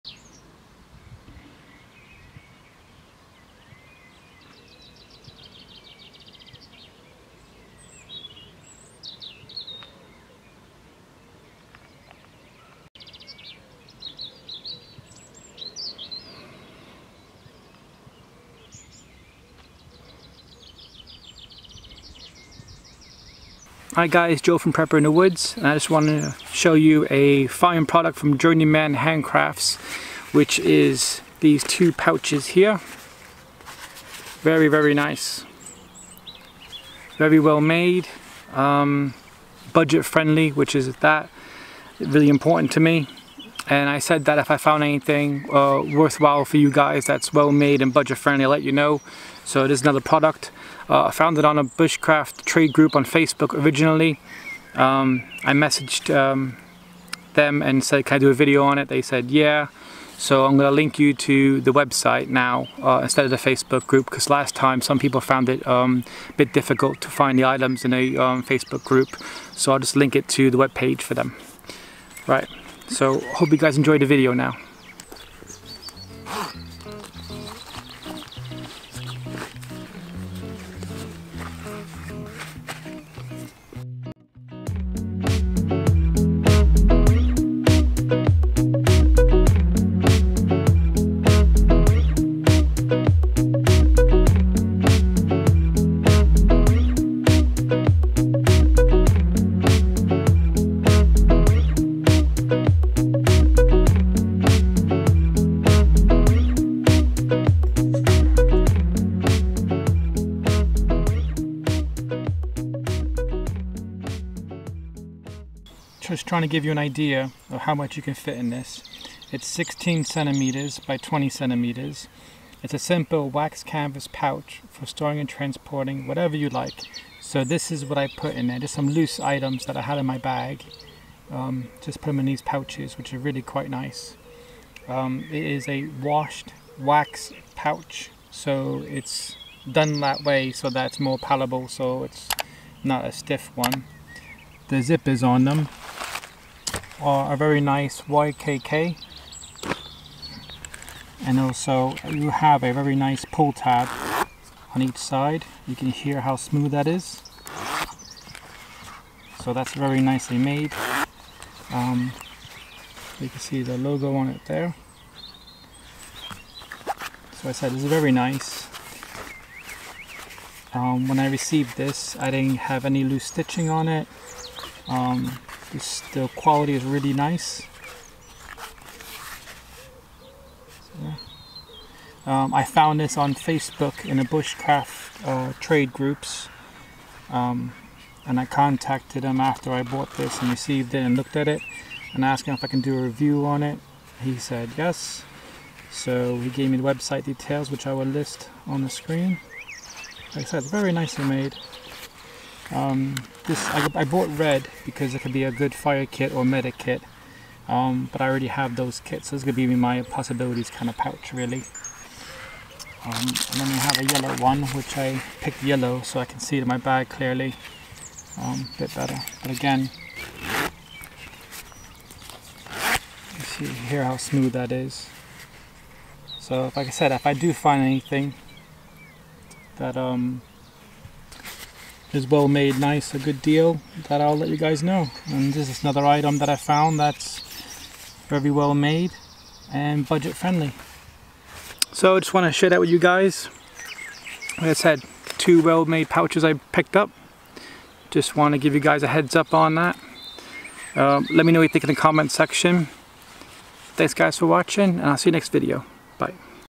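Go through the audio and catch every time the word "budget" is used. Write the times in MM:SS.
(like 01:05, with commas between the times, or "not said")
00:39, 00:47, 04:00.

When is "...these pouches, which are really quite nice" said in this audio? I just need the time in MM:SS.
02:12.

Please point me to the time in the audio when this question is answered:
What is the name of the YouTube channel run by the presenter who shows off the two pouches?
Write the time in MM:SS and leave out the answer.
00:24.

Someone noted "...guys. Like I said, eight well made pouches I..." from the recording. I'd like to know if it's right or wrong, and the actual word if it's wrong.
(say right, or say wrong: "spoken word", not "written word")
wrong: "two", not "eight".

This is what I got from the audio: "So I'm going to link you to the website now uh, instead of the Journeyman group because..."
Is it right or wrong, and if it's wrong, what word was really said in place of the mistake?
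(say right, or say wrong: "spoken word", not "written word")
wrong: "Facebook", not "Journeyman".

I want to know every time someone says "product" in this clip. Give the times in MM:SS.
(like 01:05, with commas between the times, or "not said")
00:27, 00:50.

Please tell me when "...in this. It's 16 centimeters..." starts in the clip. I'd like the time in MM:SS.
01:58.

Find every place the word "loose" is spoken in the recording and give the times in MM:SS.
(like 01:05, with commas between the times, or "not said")
02:08, 02:53.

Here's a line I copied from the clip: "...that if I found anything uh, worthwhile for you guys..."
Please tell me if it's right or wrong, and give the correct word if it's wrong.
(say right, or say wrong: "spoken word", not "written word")
right.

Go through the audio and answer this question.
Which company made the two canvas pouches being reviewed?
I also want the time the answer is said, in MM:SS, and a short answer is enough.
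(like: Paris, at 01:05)
Journeyman Handcrafts, at 00:28.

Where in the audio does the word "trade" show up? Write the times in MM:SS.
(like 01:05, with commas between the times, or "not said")
00:52, 03:05.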